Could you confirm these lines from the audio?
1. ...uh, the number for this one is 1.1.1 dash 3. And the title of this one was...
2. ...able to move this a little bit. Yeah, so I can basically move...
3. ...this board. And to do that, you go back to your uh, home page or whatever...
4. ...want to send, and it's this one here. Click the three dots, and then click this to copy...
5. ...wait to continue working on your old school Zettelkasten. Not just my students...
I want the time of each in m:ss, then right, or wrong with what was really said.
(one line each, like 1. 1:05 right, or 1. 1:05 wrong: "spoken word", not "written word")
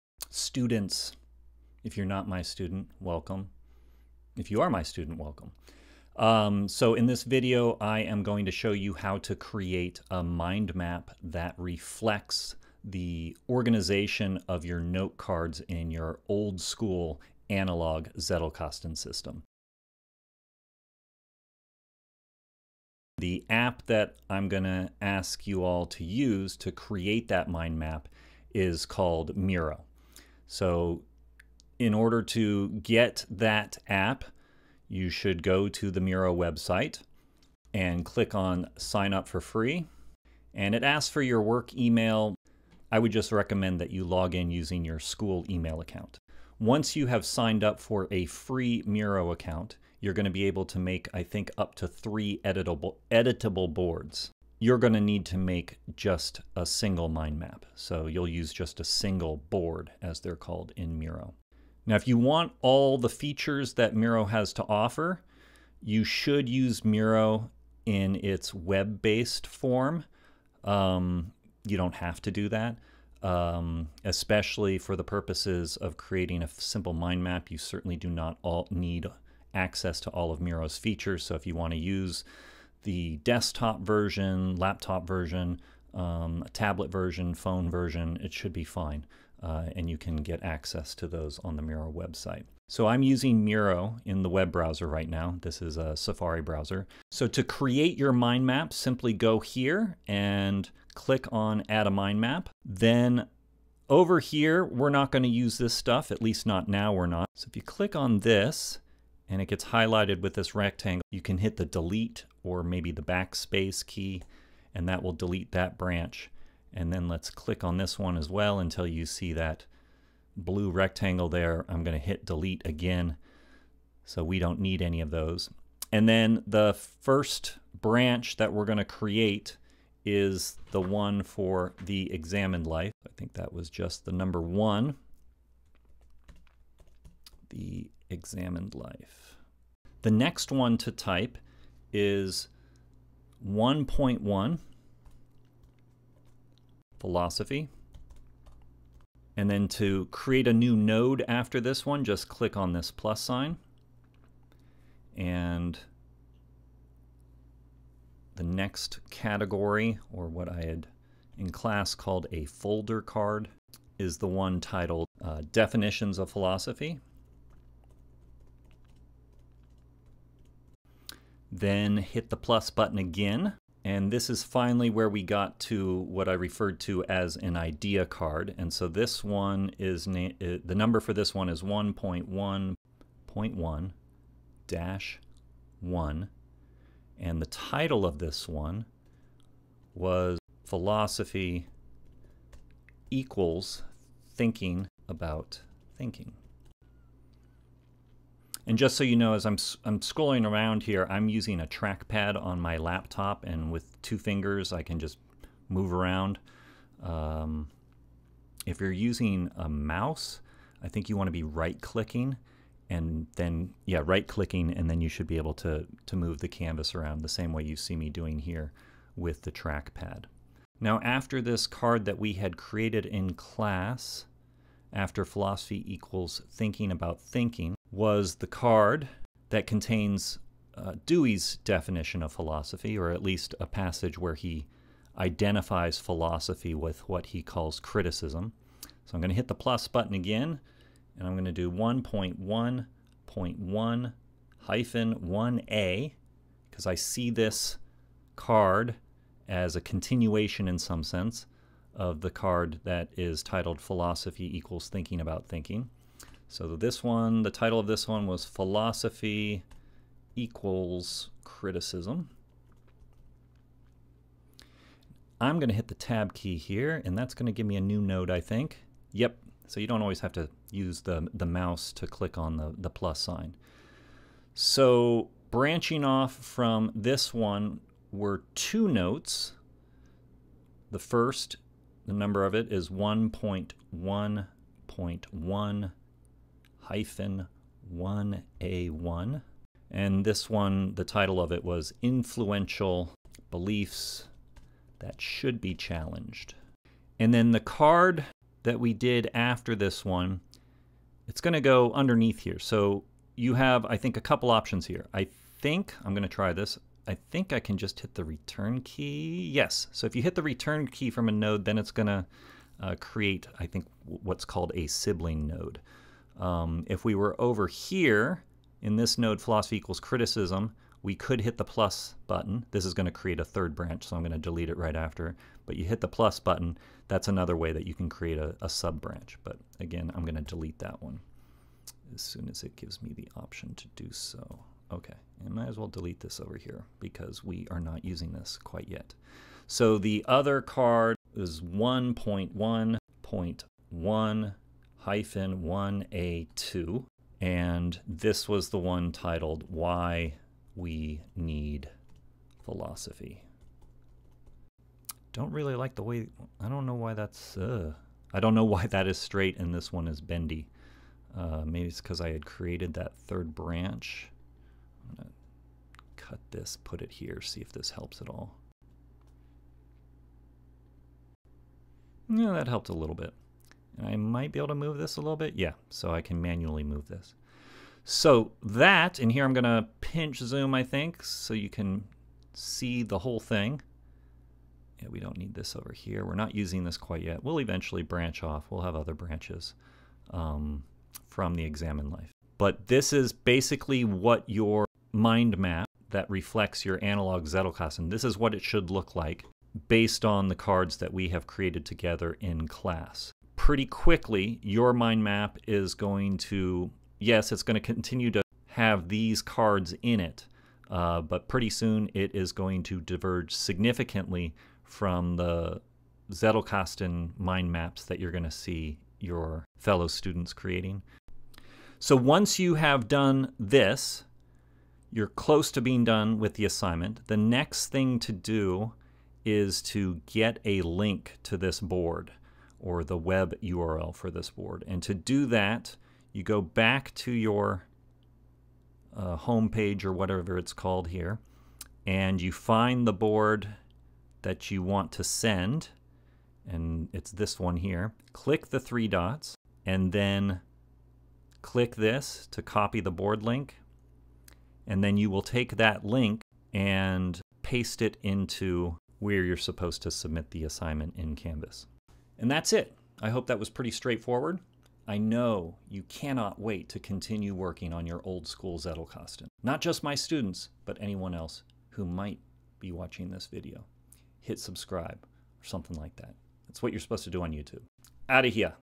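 1. 3:00 wrong: "1", not "3"
2. 6:14 wrong: "manually", not "basically"
3. 7:14 right
4. 7:24 right
5. 7:46 right.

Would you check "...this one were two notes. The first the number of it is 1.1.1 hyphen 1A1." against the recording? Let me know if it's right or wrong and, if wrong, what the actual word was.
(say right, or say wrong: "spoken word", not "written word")
right.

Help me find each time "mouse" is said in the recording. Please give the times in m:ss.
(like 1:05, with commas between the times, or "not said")
3:29, 4:31.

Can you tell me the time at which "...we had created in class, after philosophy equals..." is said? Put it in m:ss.
3:42.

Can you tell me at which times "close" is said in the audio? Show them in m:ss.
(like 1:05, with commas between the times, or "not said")
7:05.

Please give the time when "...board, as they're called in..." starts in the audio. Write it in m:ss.
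0:59.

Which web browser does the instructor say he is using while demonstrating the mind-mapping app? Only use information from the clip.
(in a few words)
Safari.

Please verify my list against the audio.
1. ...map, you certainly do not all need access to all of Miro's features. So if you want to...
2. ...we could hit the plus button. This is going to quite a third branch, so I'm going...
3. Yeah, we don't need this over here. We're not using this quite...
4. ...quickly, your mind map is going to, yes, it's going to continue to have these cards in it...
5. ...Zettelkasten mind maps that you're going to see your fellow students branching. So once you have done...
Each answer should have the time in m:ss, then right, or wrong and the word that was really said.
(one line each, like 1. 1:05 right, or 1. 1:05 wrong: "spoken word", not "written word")
1. 1:17 right
2. 5:21 wrong: "create", not "quite"
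3. 6:25 right
4. 6:43 right
5. 6:56 wrong: "creating", not "branching".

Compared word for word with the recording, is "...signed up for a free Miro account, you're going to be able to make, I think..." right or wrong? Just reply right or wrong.
right.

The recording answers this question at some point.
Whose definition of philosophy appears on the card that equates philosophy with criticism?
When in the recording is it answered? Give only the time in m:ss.
3:51.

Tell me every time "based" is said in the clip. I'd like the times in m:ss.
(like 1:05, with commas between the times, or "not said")
1:08, 6:39.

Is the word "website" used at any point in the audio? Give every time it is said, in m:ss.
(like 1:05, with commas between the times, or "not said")
0:36, 1:31.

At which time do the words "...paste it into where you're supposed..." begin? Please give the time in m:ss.
7:37.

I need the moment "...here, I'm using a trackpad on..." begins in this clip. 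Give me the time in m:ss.
3:20.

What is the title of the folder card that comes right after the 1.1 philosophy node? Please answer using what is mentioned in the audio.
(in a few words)
Definitions of Philosophy.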